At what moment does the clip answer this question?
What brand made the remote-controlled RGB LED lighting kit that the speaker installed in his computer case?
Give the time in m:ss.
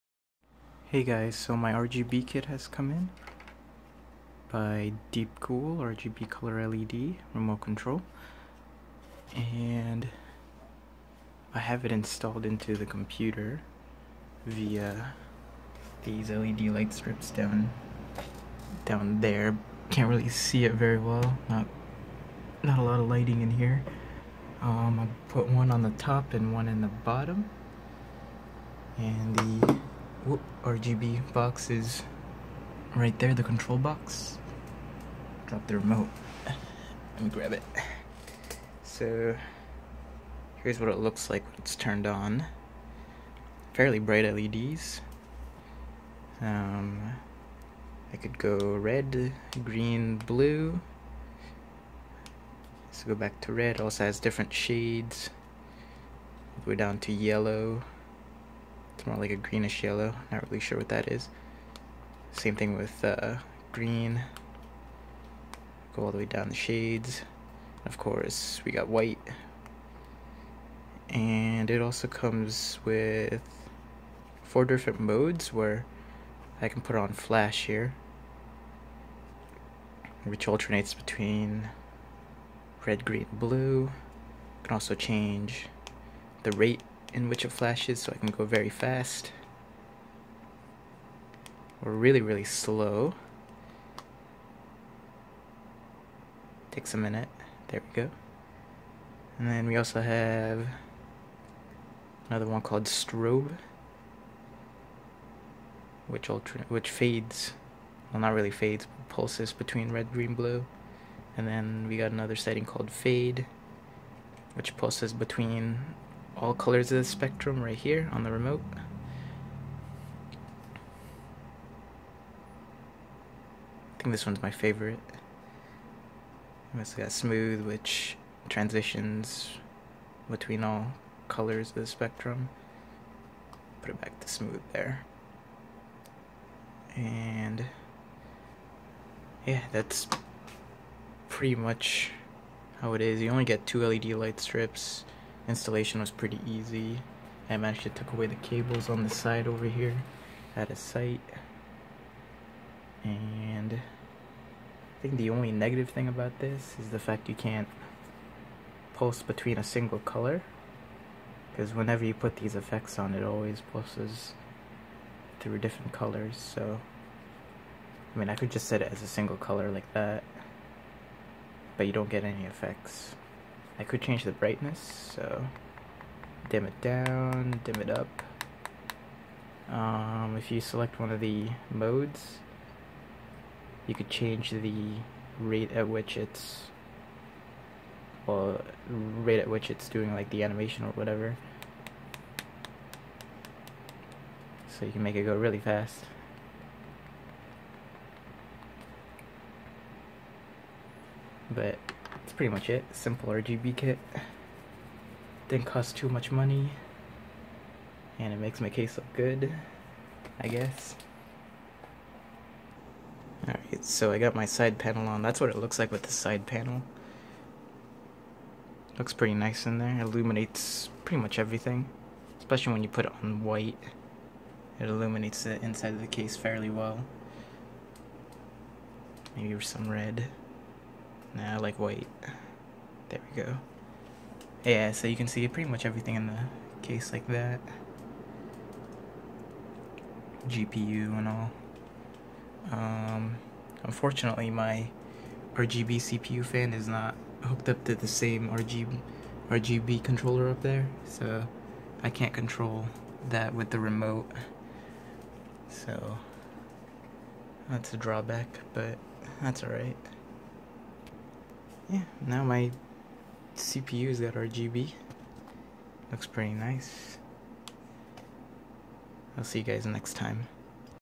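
0:05.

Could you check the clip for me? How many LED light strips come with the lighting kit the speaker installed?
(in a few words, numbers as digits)
2.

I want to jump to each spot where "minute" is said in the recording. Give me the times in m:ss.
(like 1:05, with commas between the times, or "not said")
1:36.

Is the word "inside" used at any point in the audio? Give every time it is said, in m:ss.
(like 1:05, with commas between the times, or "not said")
3:45.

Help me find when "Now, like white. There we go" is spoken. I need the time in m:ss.
3:51.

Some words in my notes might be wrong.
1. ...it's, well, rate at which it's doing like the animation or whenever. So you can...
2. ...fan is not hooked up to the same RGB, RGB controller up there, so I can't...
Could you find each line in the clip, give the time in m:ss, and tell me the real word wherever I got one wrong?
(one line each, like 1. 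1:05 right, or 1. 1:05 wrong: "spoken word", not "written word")
1. 3:06 wrong: "whatever", not "whenever"
2. 4:06 right.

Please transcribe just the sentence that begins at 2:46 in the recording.
So, I mean, I could just set it as a single color like that, but you don't get any effects.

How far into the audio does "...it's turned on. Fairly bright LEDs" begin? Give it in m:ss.
0:41.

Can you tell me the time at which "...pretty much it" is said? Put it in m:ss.
3:22.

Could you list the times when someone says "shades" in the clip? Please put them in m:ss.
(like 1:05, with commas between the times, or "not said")
0:54, 1:06.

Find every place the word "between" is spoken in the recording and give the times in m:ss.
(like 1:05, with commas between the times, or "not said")
1:20, 1:49, 1:55, 2:10, 2:39.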